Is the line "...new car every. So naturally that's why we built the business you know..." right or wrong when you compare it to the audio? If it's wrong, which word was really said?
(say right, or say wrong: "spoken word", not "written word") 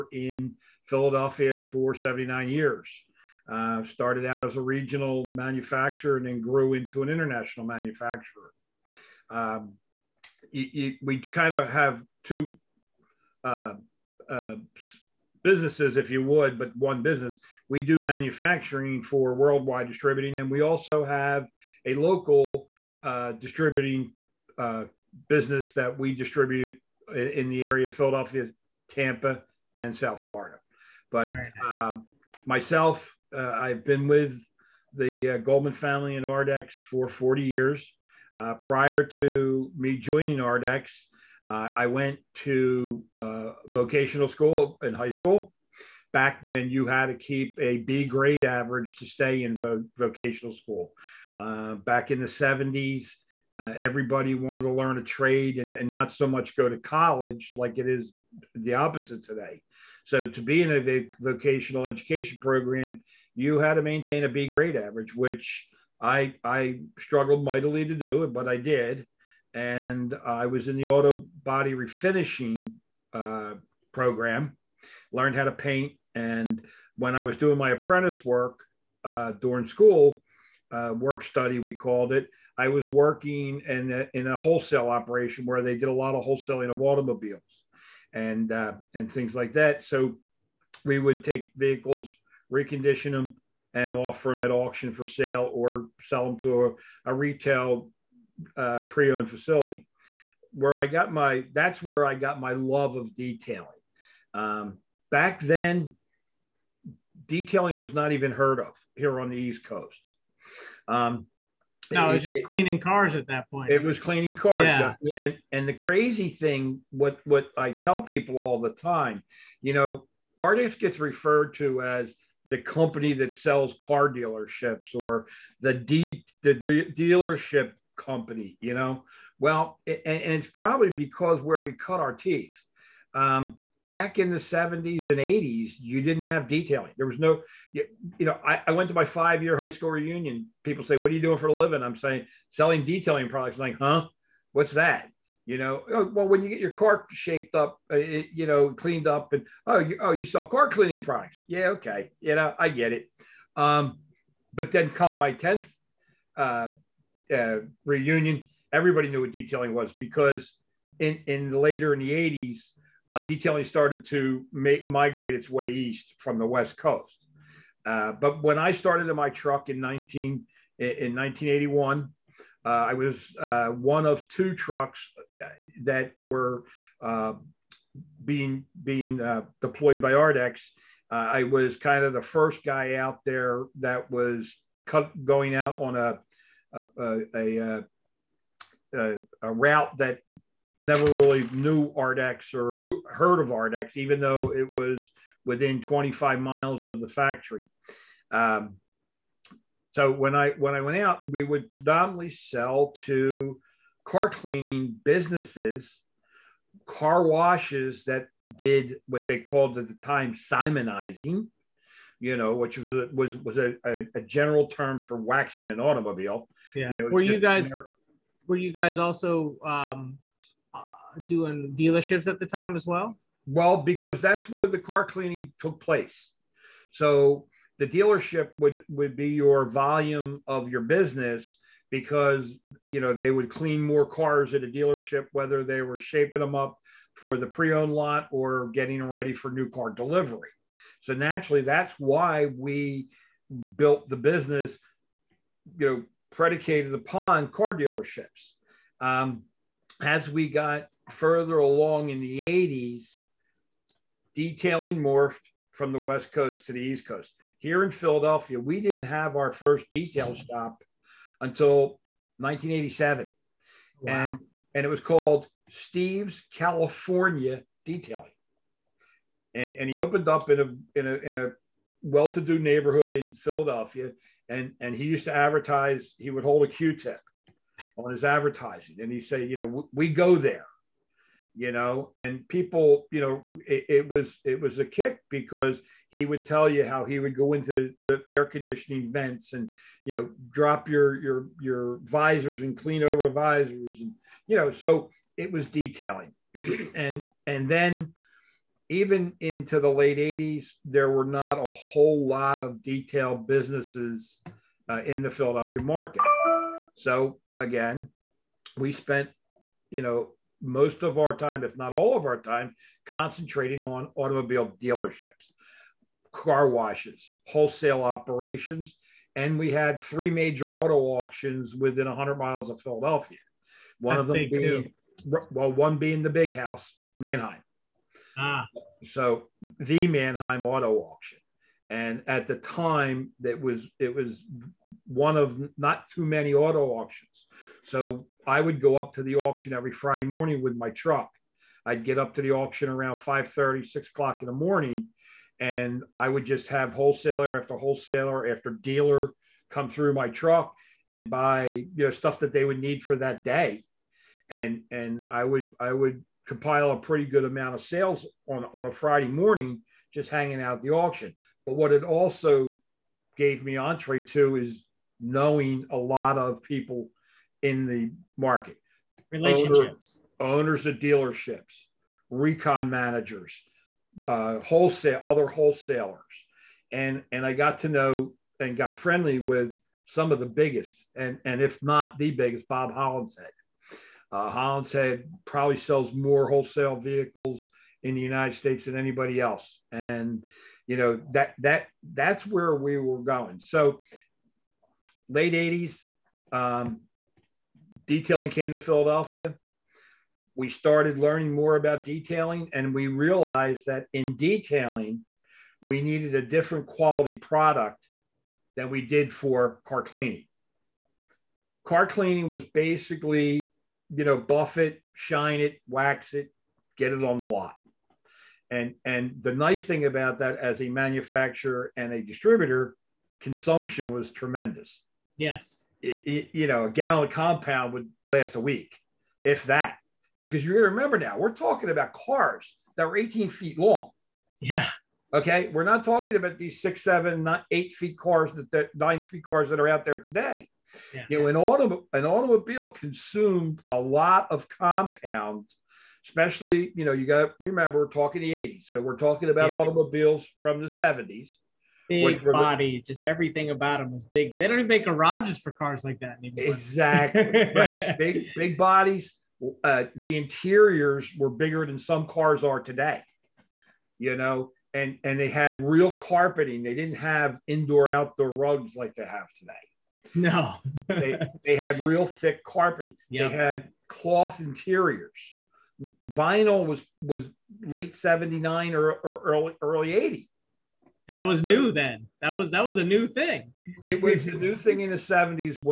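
wrong: "delivery", not "every".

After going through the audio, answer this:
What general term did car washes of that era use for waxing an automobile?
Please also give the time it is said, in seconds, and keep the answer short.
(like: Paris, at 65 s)
simonizing, at 210 s.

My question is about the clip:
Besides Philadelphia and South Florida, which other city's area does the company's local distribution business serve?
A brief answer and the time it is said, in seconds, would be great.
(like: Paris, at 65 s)
Tampa, at 28 s.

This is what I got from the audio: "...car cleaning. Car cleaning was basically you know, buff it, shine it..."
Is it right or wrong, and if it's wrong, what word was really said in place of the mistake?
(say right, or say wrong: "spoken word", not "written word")
right.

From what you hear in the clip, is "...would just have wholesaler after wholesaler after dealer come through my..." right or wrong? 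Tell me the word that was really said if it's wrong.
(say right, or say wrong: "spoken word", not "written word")
right.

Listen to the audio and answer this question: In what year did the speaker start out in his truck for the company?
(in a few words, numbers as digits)
1981.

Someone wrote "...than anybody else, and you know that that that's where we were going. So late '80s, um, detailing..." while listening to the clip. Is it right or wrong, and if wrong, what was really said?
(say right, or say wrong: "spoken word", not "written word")
right.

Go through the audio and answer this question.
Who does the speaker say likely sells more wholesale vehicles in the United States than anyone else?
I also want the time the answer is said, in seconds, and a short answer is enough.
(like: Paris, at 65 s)
Bob Hollinshead, at 382 s.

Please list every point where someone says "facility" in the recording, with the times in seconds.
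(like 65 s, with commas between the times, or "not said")
99 s.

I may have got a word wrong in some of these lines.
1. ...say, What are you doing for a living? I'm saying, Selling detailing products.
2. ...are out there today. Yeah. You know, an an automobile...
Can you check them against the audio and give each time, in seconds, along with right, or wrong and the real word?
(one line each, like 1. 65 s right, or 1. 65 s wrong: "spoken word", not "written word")
1. 140 s right
2. 439 s right.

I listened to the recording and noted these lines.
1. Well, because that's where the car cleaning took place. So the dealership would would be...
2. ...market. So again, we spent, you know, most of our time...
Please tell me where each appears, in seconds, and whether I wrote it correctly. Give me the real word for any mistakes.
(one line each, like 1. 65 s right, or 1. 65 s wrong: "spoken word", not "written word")
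1. 223 s right
2. 305 s right.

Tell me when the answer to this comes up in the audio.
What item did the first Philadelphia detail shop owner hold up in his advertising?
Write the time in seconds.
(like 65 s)
276 s.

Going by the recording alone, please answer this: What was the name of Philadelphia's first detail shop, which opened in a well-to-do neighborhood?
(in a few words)
Steve's California Detailing.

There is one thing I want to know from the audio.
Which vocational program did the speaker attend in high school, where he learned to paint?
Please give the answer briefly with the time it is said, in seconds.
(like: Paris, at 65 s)
auto body refinishing, at 70 s.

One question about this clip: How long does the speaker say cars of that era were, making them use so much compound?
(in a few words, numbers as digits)
18 feet.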